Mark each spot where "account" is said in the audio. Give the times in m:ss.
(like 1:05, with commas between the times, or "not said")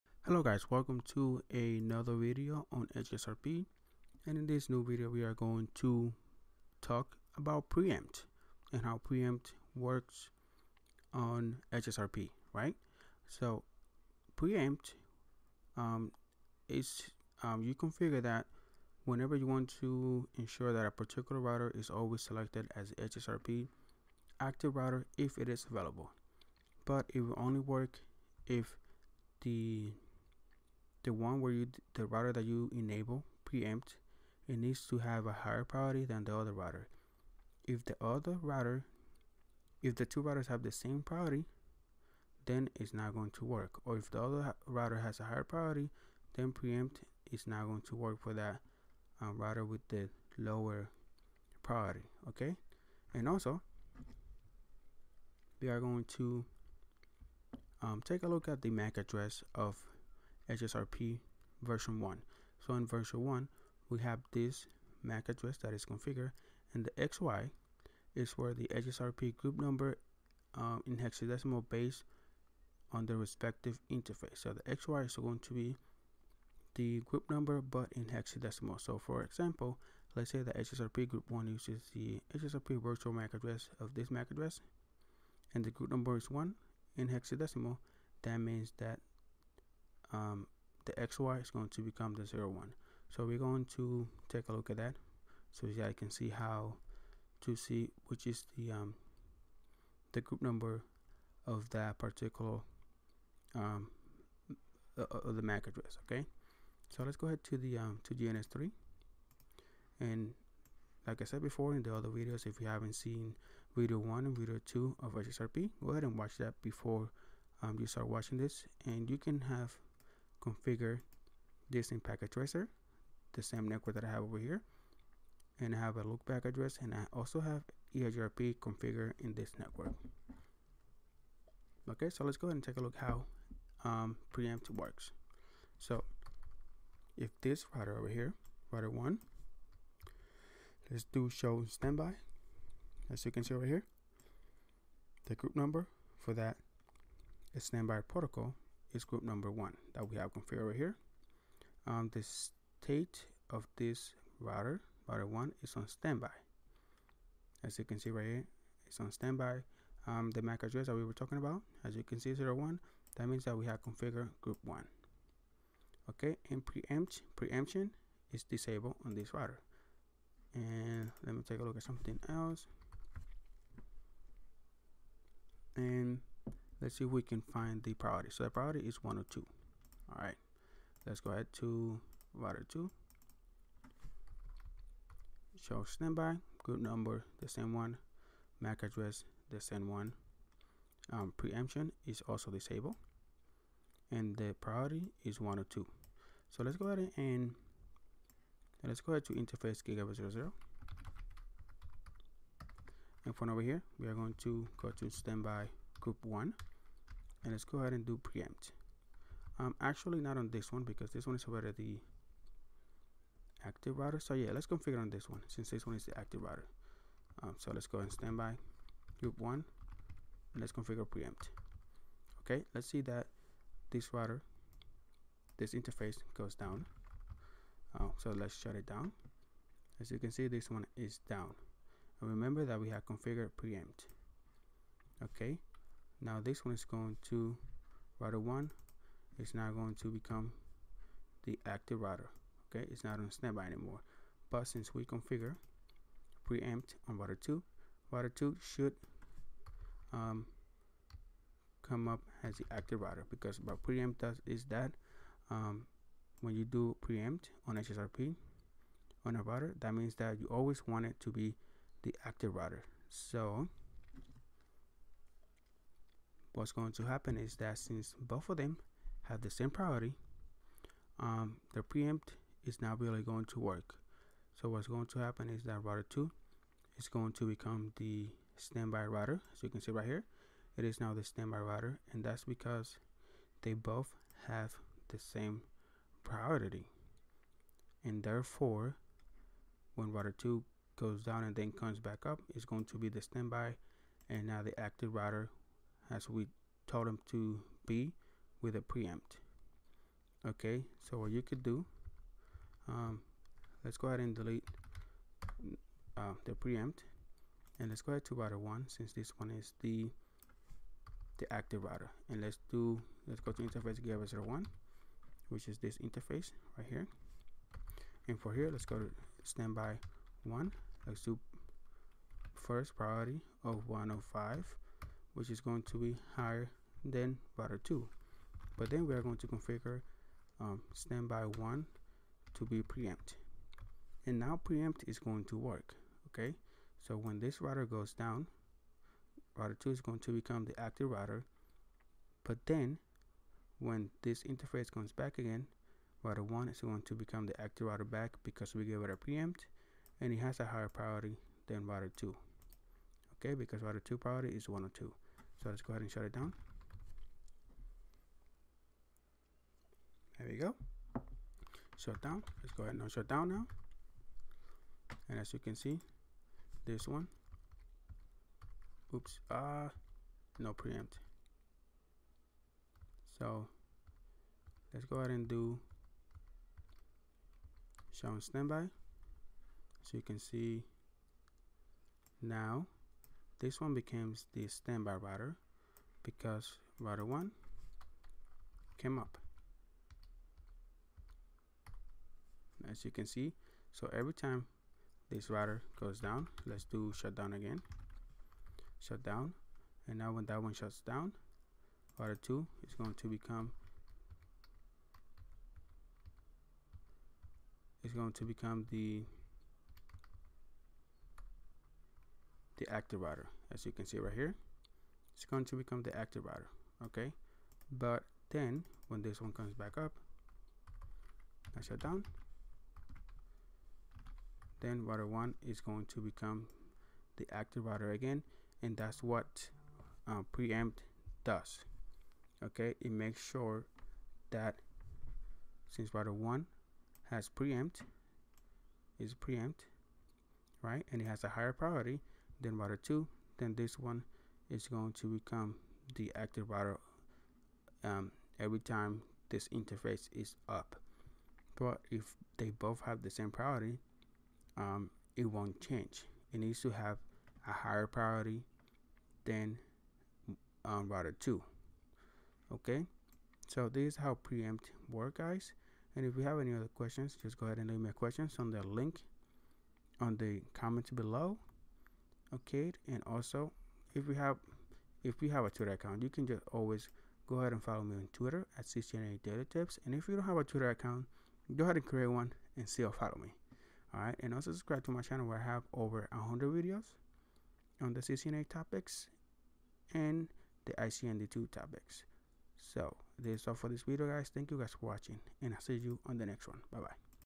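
7:55, 8:00.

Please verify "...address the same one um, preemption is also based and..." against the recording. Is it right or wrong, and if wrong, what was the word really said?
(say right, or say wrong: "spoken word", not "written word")
wrong: "disabled", not "based".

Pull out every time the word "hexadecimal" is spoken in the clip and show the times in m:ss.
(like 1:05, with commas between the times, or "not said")
1:10, 1:18, 1:27.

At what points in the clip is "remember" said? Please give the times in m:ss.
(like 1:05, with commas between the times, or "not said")
3:52.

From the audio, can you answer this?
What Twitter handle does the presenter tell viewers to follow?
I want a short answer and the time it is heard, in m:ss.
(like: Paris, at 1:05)
CCNA Daily Tips, at 7:58.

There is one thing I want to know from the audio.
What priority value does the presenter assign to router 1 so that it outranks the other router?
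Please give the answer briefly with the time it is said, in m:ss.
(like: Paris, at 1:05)
105, at 5:23.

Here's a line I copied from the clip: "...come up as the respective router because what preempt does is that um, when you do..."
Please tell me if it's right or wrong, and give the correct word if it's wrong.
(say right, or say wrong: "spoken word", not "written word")
wrong: "active", not "respective".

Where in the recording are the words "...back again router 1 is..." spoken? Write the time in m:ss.
5:45.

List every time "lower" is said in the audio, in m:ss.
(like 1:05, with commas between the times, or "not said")
0:50.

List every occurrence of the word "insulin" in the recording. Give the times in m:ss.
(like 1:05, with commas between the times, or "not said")
not said.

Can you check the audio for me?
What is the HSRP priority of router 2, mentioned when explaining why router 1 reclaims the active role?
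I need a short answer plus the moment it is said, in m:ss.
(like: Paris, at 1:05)
102, at 5:54.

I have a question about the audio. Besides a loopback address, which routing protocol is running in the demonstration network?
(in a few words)
EIGRP.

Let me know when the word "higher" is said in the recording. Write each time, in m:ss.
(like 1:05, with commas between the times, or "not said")
0:35, 0:45, 5:26, 5:50, 7:21, 7:37.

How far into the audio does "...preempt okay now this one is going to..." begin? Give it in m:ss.
3:53.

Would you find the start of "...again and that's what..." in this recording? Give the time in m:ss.
7:08.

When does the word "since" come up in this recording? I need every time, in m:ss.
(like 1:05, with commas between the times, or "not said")
3:35, 4:04, 4:27, 5:08, 7:15.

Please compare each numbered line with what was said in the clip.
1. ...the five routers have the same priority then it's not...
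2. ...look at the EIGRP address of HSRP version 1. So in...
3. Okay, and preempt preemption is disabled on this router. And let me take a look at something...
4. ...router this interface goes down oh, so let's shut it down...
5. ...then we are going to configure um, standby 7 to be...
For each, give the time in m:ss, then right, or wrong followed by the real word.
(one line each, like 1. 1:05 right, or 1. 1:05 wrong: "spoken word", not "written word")
1. 0:39 wrong: "two", not "five"
2. 0:58 wrong: "MAC", not "EIGRP"
3. 2:46 right
4. 3:44 right
5. 5:28 wrong: "1", not "7".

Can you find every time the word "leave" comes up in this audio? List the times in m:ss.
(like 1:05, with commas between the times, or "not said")
7:47.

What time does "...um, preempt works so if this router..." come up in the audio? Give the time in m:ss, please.
2:13.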